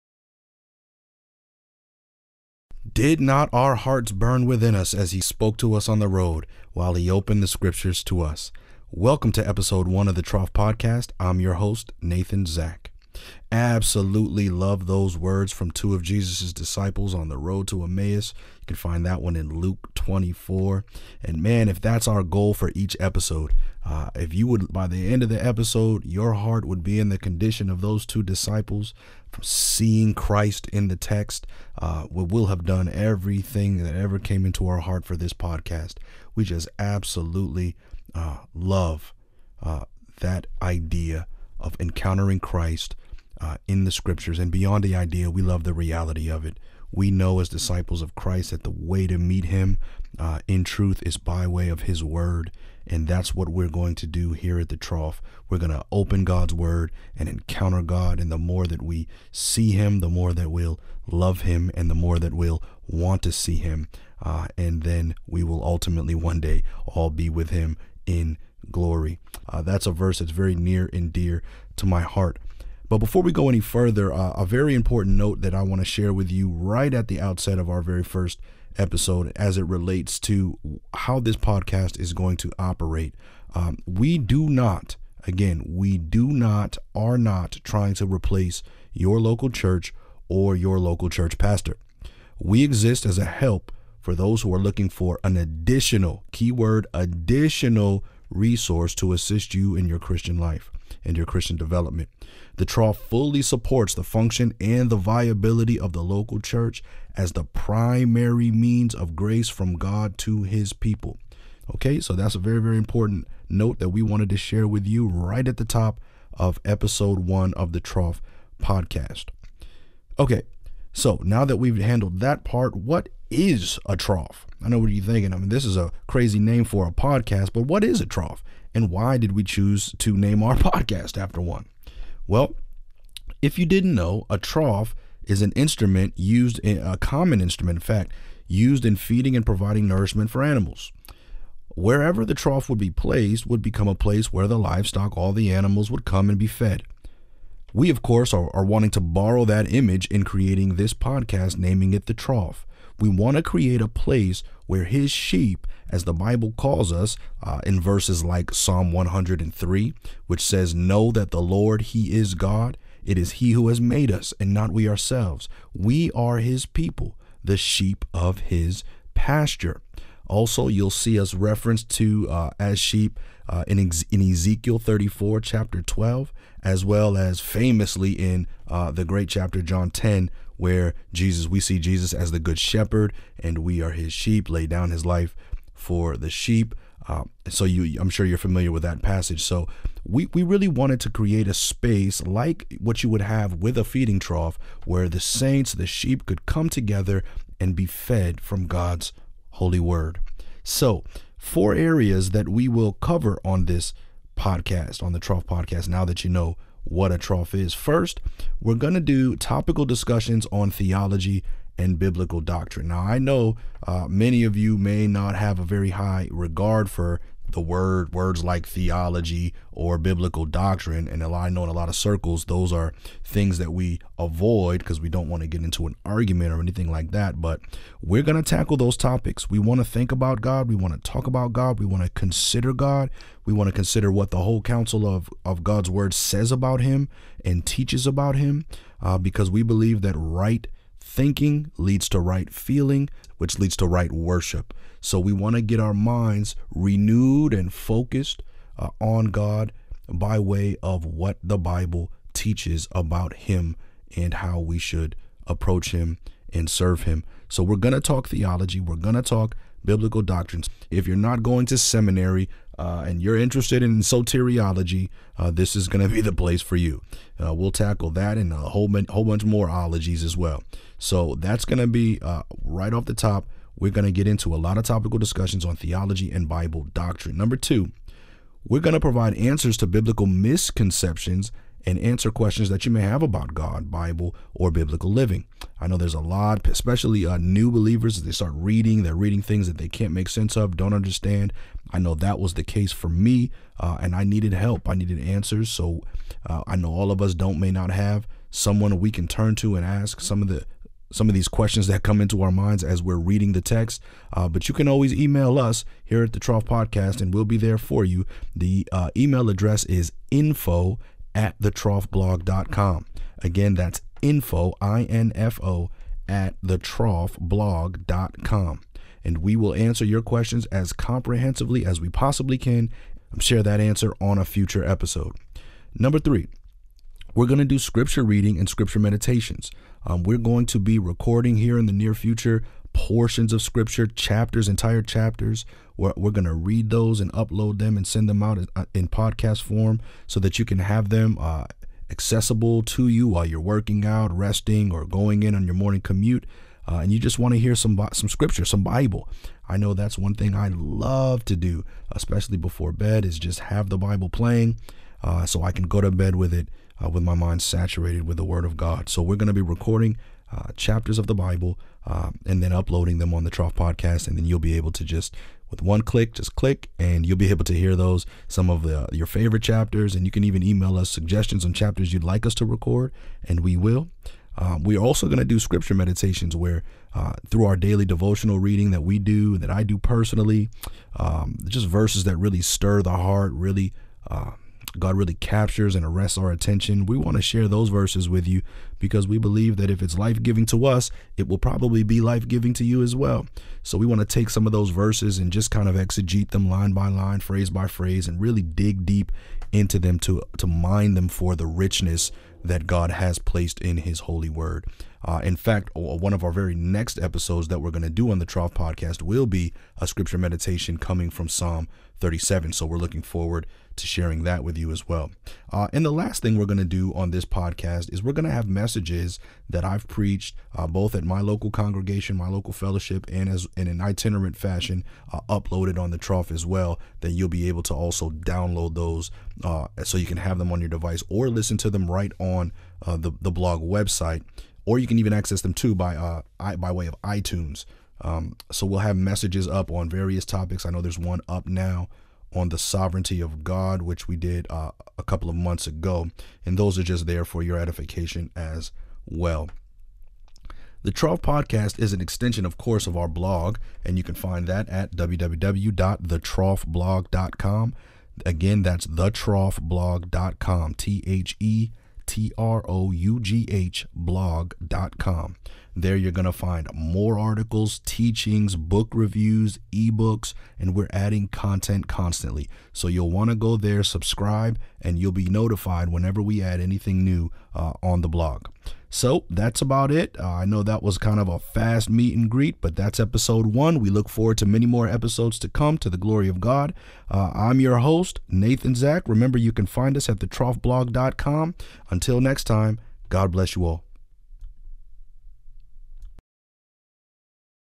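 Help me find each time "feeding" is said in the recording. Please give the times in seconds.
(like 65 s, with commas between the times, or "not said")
138 s, 193 s.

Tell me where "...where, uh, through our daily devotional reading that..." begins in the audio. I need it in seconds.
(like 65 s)
376 s.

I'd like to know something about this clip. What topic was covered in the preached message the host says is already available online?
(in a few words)
Sovereignty of God.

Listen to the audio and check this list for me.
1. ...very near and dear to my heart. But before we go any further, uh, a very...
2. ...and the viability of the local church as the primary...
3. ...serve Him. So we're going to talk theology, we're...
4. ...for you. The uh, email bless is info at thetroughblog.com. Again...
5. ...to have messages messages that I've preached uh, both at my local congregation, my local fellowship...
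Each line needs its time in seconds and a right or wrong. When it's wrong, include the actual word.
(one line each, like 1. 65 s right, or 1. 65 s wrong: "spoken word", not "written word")
1. 70 s right
2. 104 s right
3. 256 s right
4. 307 s wrong: "address", not "bless"
5. 418 s right.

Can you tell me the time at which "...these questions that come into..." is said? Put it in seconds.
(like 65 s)
301 s.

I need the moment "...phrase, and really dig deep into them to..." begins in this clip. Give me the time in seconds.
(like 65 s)
397 s.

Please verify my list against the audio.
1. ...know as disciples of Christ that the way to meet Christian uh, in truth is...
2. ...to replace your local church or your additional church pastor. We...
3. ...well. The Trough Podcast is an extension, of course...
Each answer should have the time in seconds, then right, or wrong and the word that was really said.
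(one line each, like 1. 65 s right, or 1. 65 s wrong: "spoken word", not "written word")
1. 47 s wrong: "Him", not "Christian"
2. 87 s wrong: "local", not "additional"
3. 449 s right.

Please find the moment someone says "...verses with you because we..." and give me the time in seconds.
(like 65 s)
387 s.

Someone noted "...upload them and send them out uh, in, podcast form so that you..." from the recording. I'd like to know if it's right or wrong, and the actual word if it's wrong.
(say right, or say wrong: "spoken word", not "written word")
right.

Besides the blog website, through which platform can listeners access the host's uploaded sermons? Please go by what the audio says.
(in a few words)
iTunes.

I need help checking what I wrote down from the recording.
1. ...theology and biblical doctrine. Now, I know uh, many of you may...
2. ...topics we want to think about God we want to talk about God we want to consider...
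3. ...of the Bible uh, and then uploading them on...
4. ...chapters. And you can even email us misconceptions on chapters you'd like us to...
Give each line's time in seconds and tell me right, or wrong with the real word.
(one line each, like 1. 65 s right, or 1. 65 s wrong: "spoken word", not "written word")
1. 210 s right
2. 228 s right
3. 361 s right
4. 369 s wrong: "suggestions", not "misconceptions".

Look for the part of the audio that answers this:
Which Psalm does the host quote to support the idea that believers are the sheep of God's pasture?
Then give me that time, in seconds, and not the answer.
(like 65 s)
158 s.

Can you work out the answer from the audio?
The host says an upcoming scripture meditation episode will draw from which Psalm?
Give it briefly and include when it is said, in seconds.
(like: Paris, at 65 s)
Psalm 37, at 411 s.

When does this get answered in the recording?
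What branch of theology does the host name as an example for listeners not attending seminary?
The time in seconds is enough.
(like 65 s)
263 s.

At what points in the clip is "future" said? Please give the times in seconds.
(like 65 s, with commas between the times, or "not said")
324 s, 332 s.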